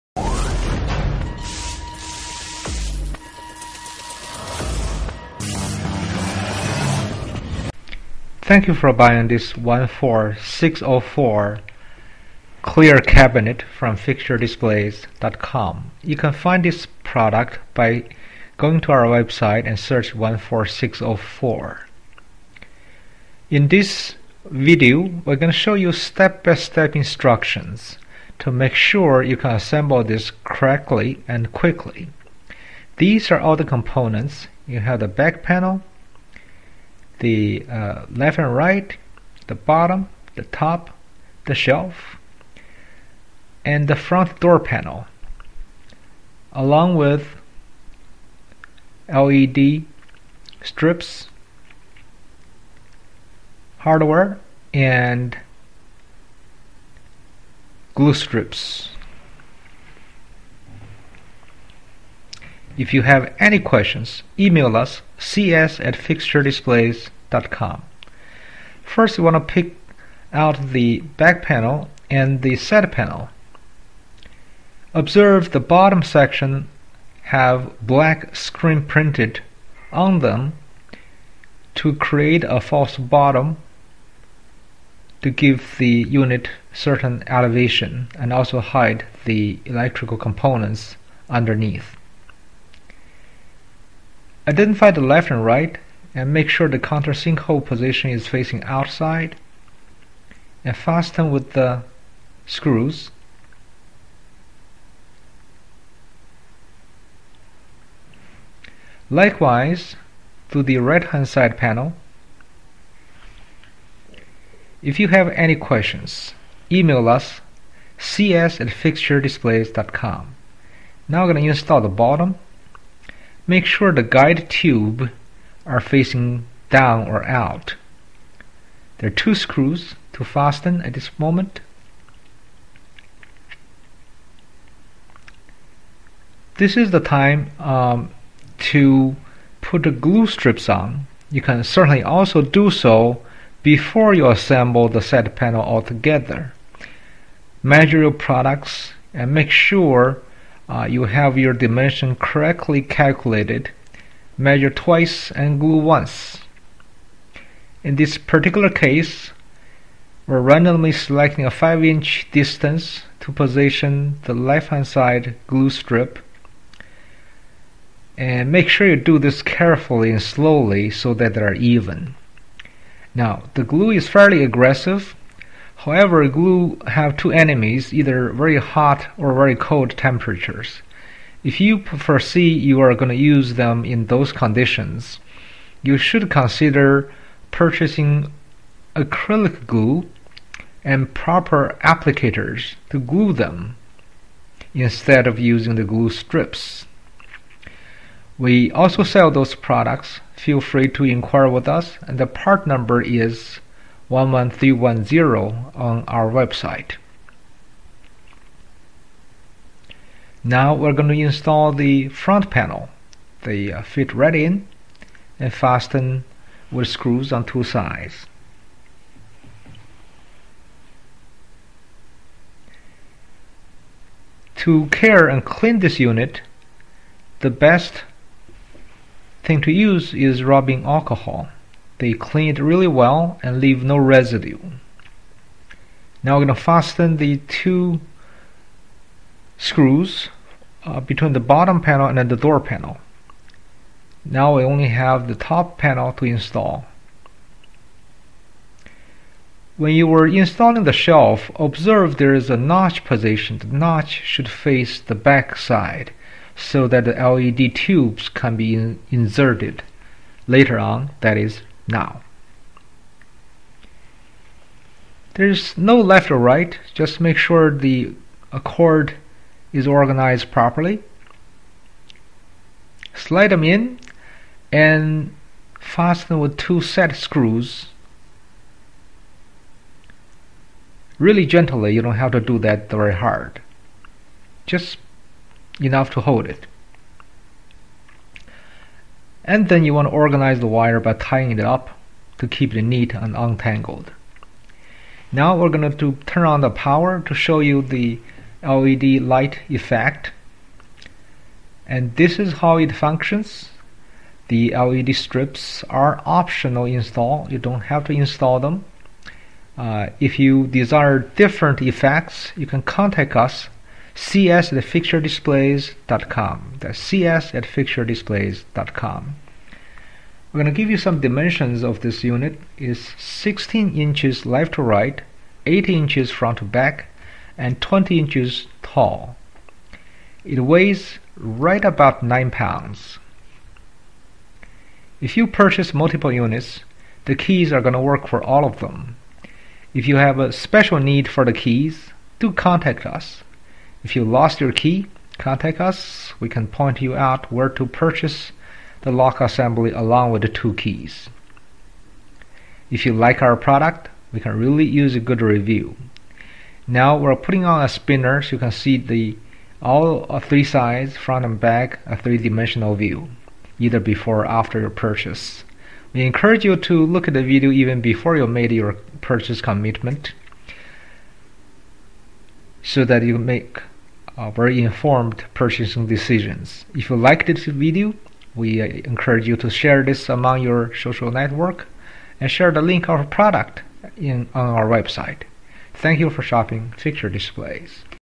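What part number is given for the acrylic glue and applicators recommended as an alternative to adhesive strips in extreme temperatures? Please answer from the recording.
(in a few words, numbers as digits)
11310.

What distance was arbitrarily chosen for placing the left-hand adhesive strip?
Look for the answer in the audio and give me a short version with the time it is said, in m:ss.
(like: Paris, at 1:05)
5 inch, at 2:41.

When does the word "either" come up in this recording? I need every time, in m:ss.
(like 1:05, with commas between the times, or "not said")
2:57, 6:03.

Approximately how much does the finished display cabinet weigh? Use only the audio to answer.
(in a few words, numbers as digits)
9 pounds.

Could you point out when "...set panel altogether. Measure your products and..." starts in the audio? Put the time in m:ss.
2:25.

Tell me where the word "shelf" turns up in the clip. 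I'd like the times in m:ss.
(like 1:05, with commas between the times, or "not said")
0:41, 4:11.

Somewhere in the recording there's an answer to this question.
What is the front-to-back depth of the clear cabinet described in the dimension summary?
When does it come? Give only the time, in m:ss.
5:25.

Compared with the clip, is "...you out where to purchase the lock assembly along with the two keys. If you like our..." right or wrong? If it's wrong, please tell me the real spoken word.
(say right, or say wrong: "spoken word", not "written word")
right.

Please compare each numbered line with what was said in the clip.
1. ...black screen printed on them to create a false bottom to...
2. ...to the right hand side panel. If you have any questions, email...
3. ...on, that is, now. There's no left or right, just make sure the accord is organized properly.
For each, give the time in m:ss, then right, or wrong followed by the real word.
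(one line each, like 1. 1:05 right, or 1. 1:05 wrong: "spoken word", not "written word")
1. 1:17 right
2. 1:50 right
3. 4:20 right.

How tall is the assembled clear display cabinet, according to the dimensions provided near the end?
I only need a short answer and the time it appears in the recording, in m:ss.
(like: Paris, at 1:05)
20 inches, at 5:27.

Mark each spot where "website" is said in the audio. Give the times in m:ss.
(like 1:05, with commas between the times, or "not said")
0:19, 3:26, 6:24.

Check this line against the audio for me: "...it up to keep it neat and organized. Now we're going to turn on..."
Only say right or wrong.
wrong.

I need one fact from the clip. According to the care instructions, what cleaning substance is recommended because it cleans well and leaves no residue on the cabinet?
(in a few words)
Rubbing alcohol.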